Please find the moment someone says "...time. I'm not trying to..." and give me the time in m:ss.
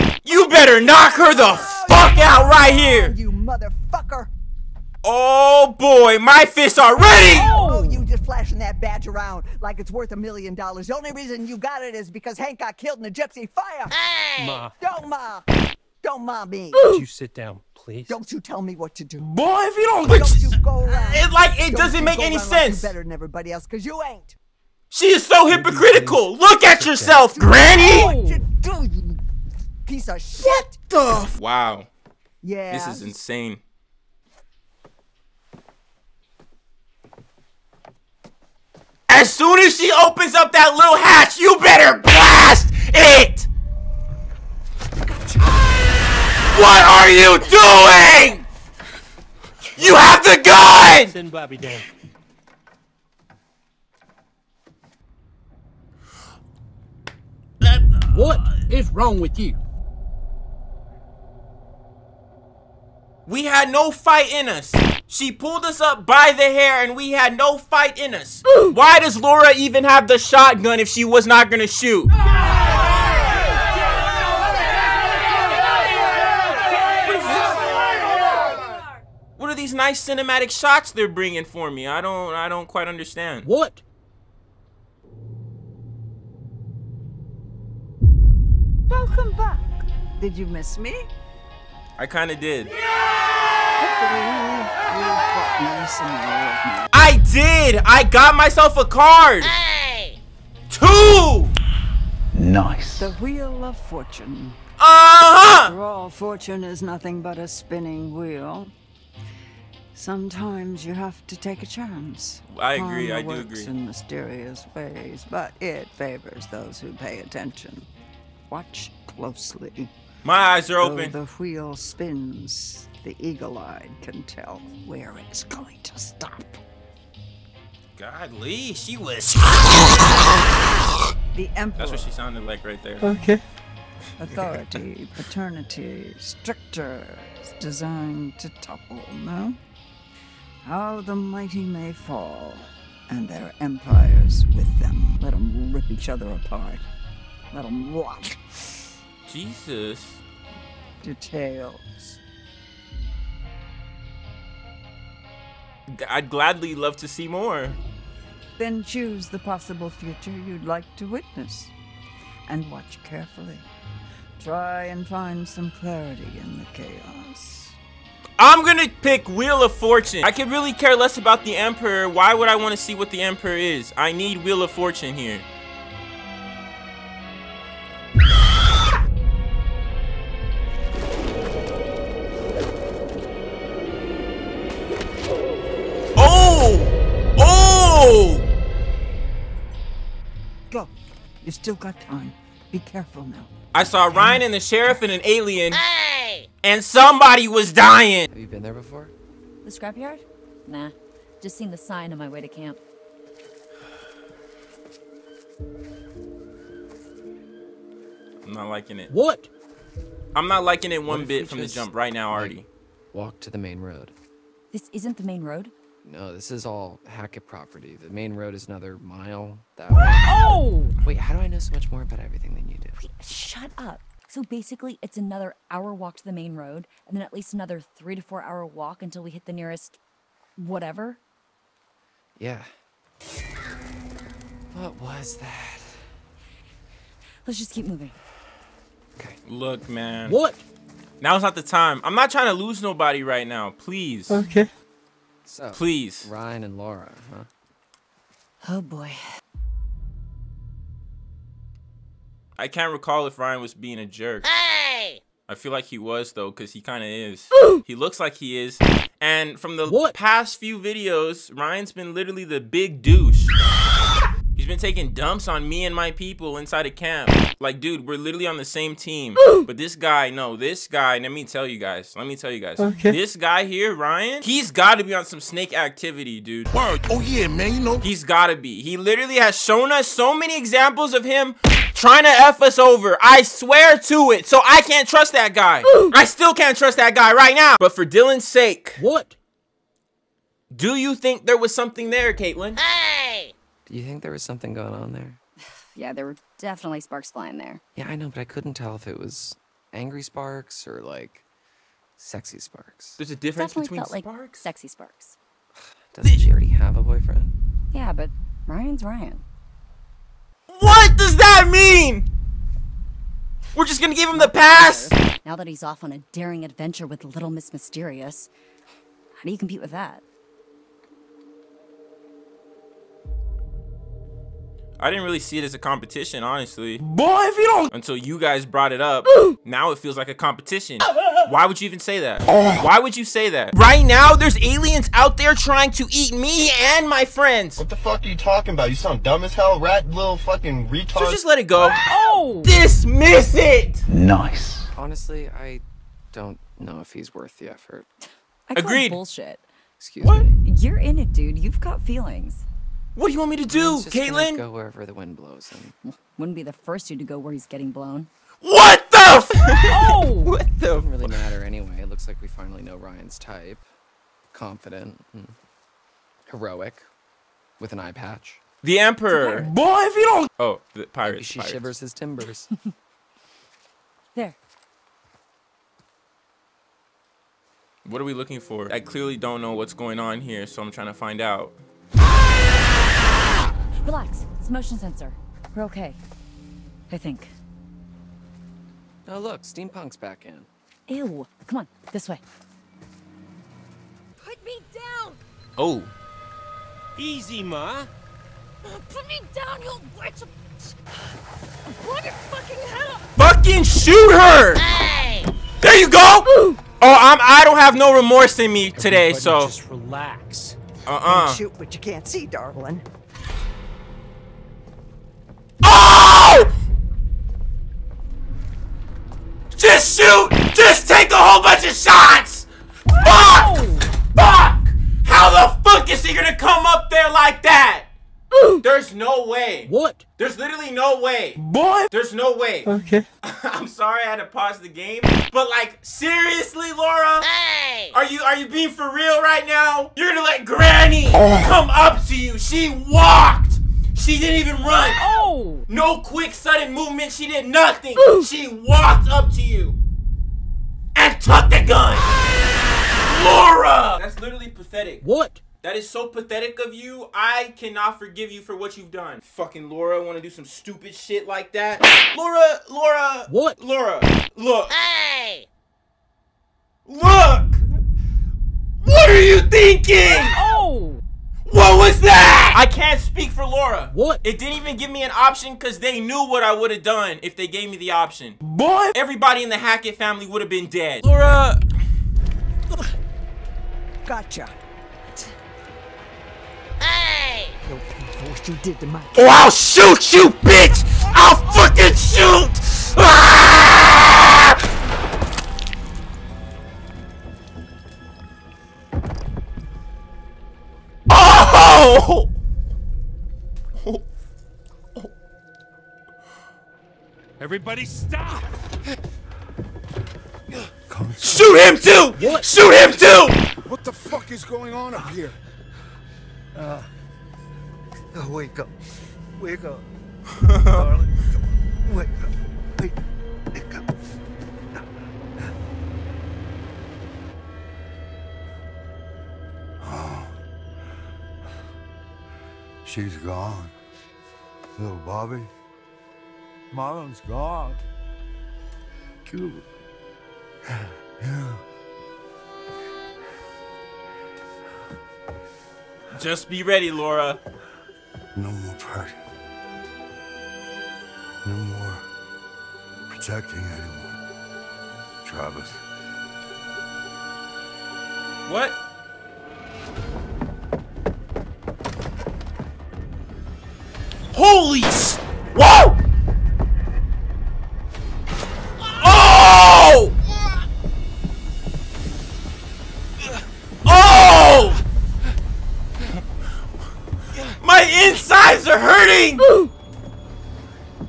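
4:01.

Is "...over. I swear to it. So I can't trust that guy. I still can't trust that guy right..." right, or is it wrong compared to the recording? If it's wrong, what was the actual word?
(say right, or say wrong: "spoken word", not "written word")
right.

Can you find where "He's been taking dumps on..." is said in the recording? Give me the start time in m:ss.
4:24.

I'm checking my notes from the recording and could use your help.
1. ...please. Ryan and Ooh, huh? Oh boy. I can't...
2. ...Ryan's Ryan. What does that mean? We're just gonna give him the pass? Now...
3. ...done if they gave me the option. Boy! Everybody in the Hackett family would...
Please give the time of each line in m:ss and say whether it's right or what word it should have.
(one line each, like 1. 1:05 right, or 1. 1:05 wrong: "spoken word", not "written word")
1. 4:05 wrong: "Laura", not "Ooh"
2. 5:08 right
3. 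7:57 right.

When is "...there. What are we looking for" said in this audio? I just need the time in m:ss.
6:14.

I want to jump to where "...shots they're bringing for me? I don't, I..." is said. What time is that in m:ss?
1:20.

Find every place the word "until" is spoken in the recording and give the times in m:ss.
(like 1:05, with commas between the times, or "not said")
3:49, 5:27.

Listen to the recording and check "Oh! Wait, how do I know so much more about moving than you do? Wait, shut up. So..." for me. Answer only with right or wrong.
wrong.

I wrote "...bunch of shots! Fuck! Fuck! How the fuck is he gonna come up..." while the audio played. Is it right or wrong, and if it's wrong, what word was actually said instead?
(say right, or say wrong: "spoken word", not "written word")
right.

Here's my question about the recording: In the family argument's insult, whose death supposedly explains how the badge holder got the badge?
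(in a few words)
Hank.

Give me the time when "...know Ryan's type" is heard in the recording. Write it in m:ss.
6:02.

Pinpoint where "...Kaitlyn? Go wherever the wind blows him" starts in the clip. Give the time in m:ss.
5:54.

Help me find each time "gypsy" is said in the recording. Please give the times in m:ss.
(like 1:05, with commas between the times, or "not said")
0:13.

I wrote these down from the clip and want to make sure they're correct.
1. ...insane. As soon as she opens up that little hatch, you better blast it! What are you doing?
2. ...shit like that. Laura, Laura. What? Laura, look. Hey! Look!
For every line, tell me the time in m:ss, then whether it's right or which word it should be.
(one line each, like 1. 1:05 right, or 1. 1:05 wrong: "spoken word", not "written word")
1. 0:33 right
2. 7:41 right.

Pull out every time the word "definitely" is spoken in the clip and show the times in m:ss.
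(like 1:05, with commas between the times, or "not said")
4:56, 5:03.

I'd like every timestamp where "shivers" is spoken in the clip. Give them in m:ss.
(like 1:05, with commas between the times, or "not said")
6:11.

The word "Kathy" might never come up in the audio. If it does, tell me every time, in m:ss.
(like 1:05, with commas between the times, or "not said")
not said.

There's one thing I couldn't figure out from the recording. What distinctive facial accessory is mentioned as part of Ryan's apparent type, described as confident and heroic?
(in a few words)
An eye patch.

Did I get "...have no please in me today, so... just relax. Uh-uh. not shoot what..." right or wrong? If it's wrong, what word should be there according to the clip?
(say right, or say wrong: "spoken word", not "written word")
wrong: "remorse", not "please".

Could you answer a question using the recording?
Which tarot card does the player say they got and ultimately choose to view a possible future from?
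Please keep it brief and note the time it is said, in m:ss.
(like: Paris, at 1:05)
The Wheel of Fortune, at 1:42.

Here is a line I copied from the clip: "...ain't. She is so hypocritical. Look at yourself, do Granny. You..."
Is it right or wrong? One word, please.
right.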